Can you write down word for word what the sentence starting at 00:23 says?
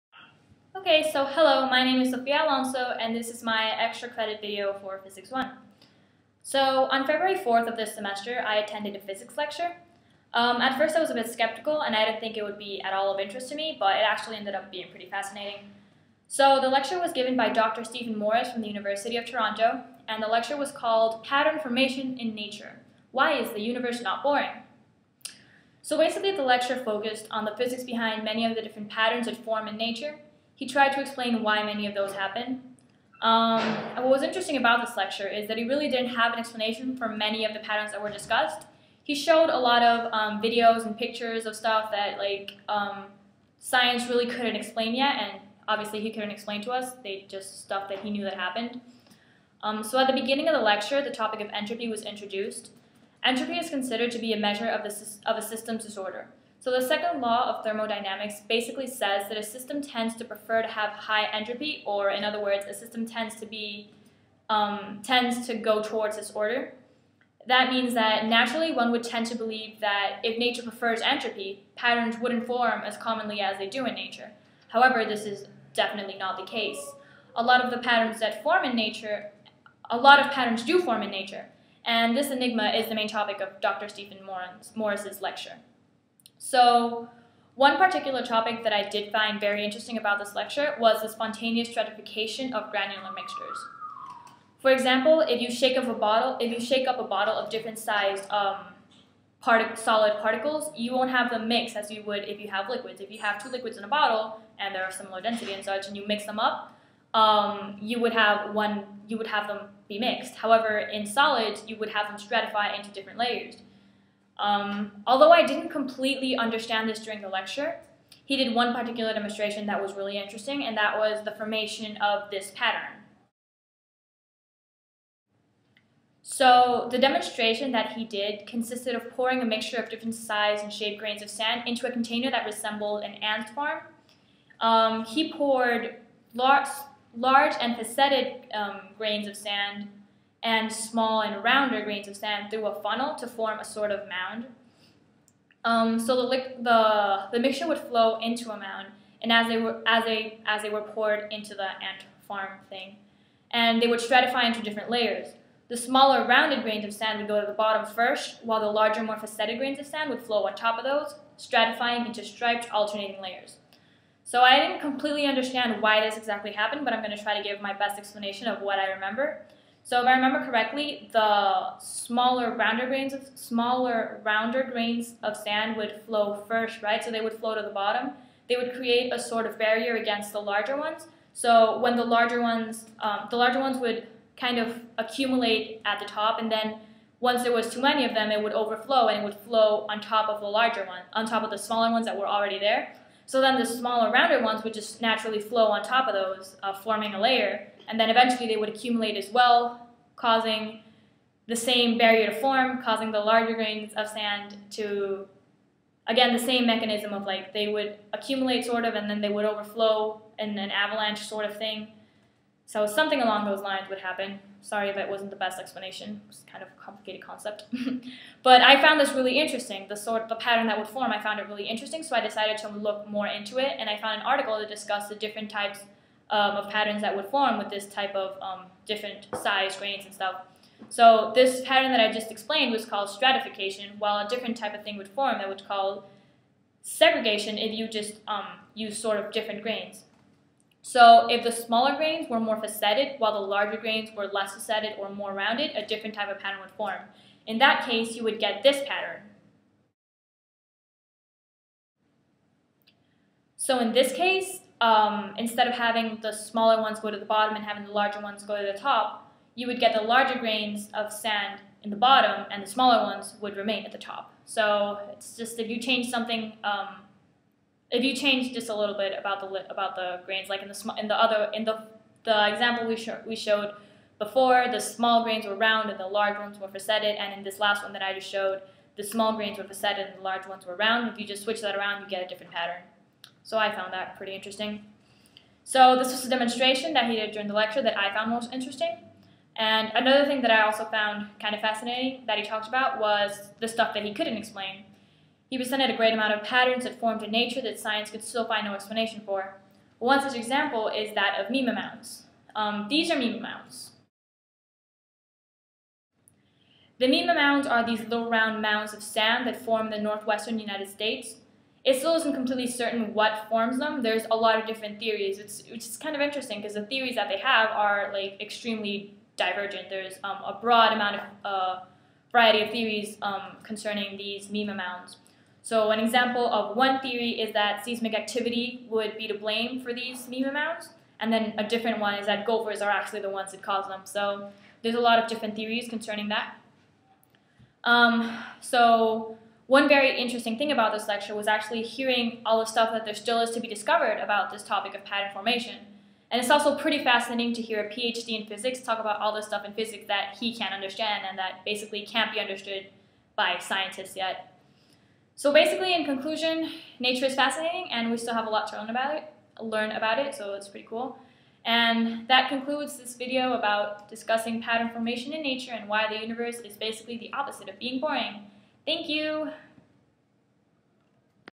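Why is the universe not boring?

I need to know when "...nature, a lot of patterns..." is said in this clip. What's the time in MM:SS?
01:18.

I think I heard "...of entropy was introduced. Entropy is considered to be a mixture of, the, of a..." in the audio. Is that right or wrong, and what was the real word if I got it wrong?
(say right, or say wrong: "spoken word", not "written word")
wrong: "measure", not "mixture".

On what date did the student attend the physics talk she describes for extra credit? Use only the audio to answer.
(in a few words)
February 4th.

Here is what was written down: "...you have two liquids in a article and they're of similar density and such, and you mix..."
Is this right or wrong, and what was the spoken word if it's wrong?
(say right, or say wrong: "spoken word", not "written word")
wrong: "bottle", not "article".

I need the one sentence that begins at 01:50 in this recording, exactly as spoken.
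However, in solids, you would have them stratify into different layers.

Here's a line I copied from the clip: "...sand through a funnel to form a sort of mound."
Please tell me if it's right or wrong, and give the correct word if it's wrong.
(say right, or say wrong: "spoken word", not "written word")
right.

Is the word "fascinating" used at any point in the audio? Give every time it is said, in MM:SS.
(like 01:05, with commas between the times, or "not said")
00:15, 04:51, 05:47, 05:57.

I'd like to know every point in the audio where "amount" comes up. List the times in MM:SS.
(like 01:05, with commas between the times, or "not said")
04:56, 05:20.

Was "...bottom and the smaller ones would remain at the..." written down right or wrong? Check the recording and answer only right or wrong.
right.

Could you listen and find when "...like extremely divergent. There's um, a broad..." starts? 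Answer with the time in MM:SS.
05:18.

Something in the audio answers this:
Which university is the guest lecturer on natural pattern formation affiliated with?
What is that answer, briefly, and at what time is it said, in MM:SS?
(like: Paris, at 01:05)
University of Toronto, at 00:18.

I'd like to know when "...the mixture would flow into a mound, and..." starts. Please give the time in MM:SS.
02:27.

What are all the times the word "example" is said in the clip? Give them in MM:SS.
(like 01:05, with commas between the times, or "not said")
01:34, 04:32, 05:00, 05:25.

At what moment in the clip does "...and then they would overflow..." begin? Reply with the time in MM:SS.
03:28.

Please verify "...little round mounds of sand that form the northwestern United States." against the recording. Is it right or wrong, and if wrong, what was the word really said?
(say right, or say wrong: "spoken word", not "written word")
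right.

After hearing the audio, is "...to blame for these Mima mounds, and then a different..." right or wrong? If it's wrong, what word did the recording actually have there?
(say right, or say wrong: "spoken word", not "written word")
right.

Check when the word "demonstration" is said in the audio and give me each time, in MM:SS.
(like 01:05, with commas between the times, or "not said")
01:59, 02:06, 04:46.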